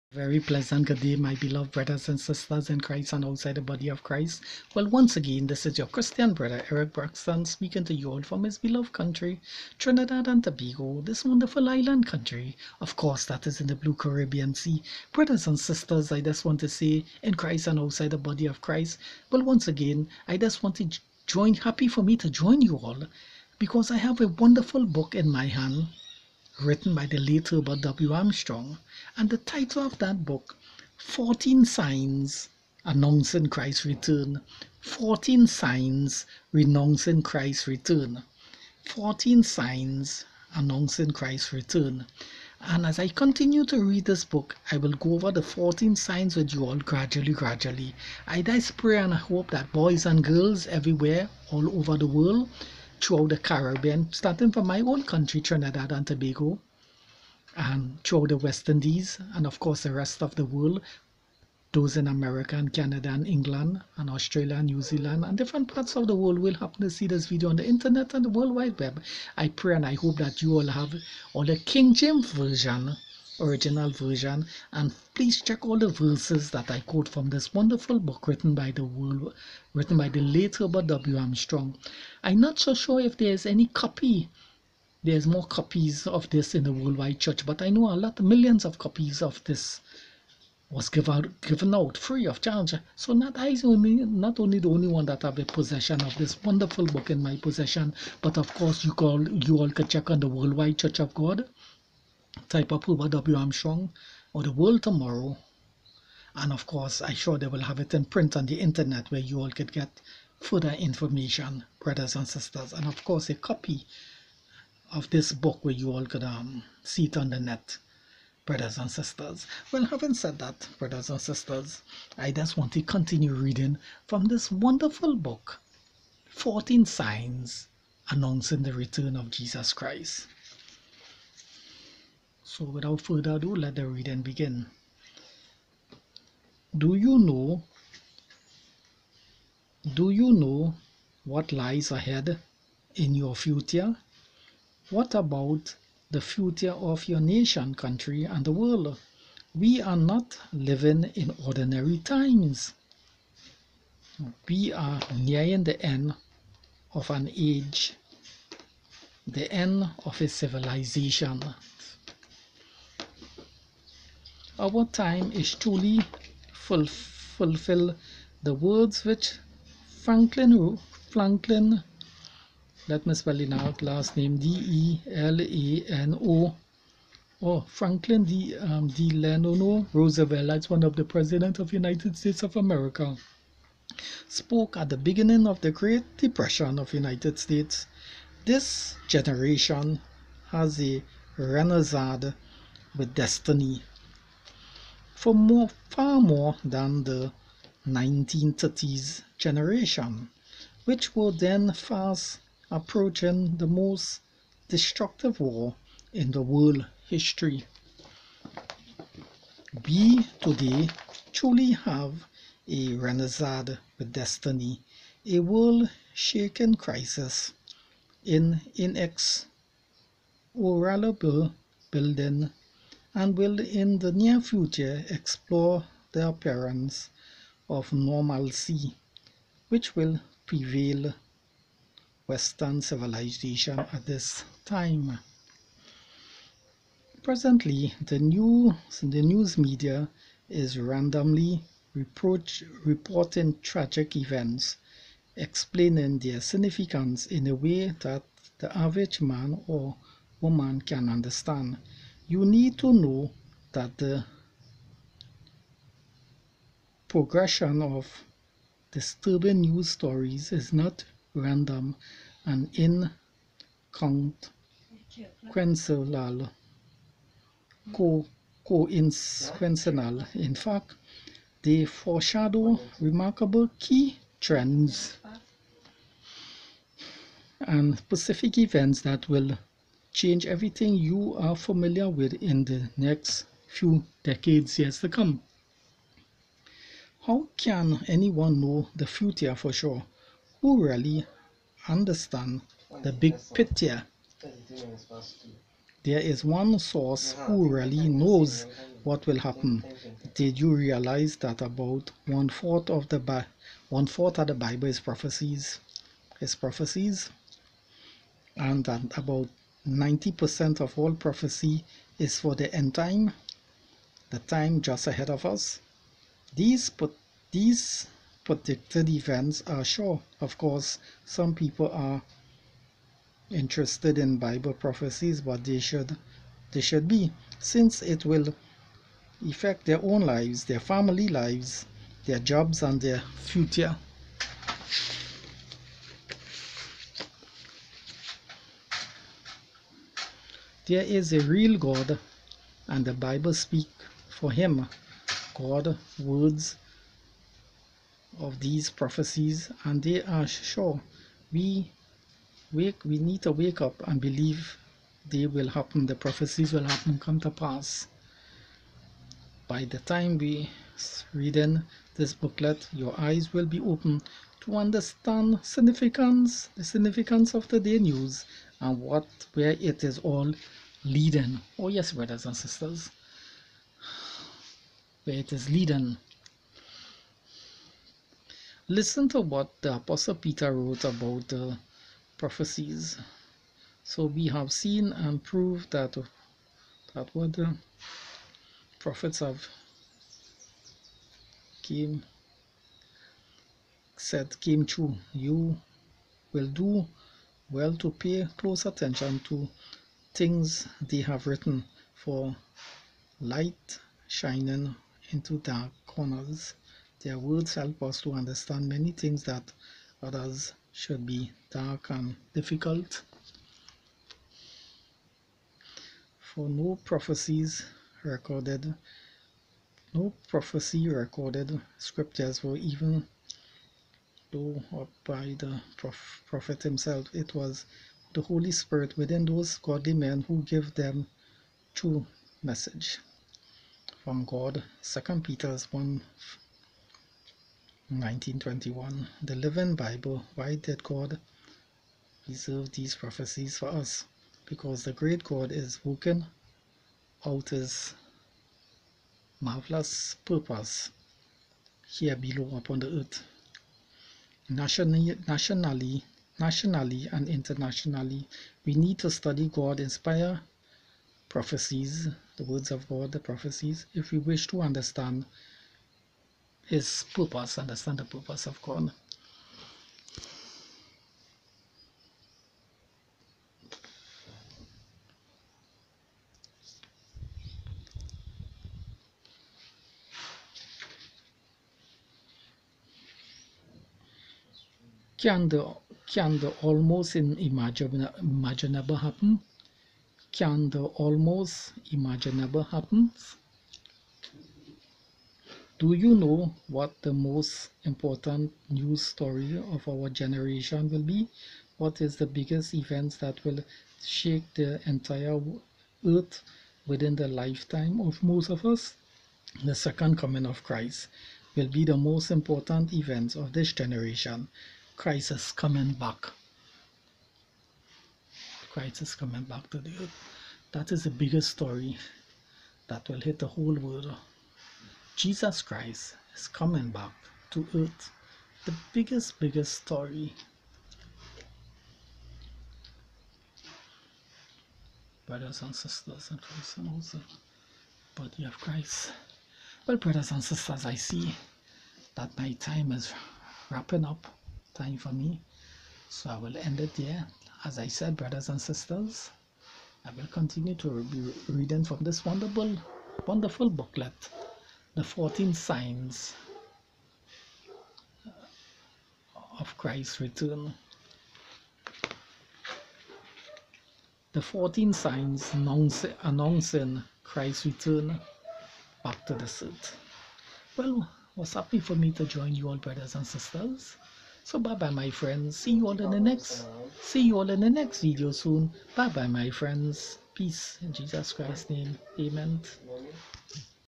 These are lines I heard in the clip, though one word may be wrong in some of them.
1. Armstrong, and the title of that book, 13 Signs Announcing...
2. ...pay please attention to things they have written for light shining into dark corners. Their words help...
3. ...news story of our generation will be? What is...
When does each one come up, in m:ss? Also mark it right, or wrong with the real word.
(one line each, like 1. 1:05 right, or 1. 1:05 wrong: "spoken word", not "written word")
1. 0:28 wrong: "14", not "13"
2. 6:38 wrong: "close", not "please"
3. 8:18 right.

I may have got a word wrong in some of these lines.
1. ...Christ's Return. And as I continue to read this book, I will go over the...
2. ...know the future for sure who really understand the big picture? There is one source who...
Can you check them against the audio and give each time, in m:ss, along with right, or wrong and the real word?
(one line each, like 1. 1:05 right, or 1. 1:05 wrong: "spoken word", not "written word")
1. 0:41 right
2. 4:48 right.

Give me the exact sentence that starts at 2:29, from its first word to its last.
We are not living in ordinary times.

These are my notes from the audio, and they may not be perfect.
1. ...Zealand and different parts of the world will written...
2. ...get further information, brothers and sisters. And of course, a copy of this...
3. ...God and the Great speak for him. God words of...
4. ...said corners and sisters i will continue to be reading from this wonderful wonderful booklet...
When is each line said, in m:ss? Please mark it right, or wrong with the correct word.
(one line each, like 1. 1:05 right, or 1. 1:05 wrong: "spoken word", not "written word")
1. 1:04 wrong: "happen", not "written"
2. 1:49 right
3. 5:41 wrong: "Bible", not "Great"
4. 9:08 wrong: "brothers", not "corners".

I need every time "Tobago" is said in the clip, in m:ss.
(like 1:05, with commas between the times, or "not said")
0:10, 0:56.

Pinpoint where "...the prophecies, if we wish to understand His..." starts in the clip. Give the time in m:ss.
7:43.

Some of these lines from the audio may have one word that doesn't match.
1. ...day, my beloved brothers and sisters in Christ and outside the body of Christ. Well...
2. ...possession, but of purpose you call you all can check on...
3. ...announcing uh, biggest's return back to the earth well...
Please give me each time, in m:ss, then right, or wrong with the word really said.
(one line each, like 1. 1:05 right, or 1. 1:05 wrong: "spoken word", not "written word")
1. 0:00 right
2. 1:37 wrong: "course", not "purpose"
3. 9:26 wrong: "christ", not "biggest".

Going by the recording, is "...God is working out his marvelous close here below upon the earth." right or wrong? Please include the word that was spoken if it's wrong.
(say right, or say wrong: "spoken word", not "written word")
wrong: "purpose", not "close".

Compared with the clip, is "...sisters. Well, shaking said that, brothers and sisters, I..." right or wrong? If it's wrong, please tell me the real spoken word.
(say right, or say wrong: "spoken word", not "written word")
wrong: "having", not "shaking".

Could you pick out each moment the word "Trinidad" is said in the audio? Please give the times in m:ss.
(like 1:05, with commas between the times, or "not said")
0:09, 0:55.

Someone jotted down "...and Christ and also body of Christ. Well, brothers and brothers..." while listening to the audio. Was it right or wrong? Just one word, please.
wrong.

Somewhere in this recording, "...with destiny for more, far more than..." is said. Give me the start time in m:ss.
3:12.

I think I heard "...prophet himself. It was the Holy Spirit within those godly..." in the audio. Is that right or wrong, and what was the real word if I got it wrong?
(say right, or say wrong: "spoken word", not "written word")
right.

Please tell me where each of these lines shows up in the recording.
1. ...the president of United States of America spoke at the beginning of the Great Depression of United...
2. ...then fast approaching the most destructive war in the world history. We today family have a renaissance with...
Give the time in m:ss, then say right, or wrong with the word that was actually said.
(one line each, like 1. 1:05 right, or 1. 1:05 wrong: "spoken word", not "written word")
1. 3:00 right
2. 3:21 wrong: "truly", not "family".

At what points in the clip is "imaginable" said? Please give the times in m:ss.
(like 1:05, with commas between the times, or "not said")
8:07, 8:12.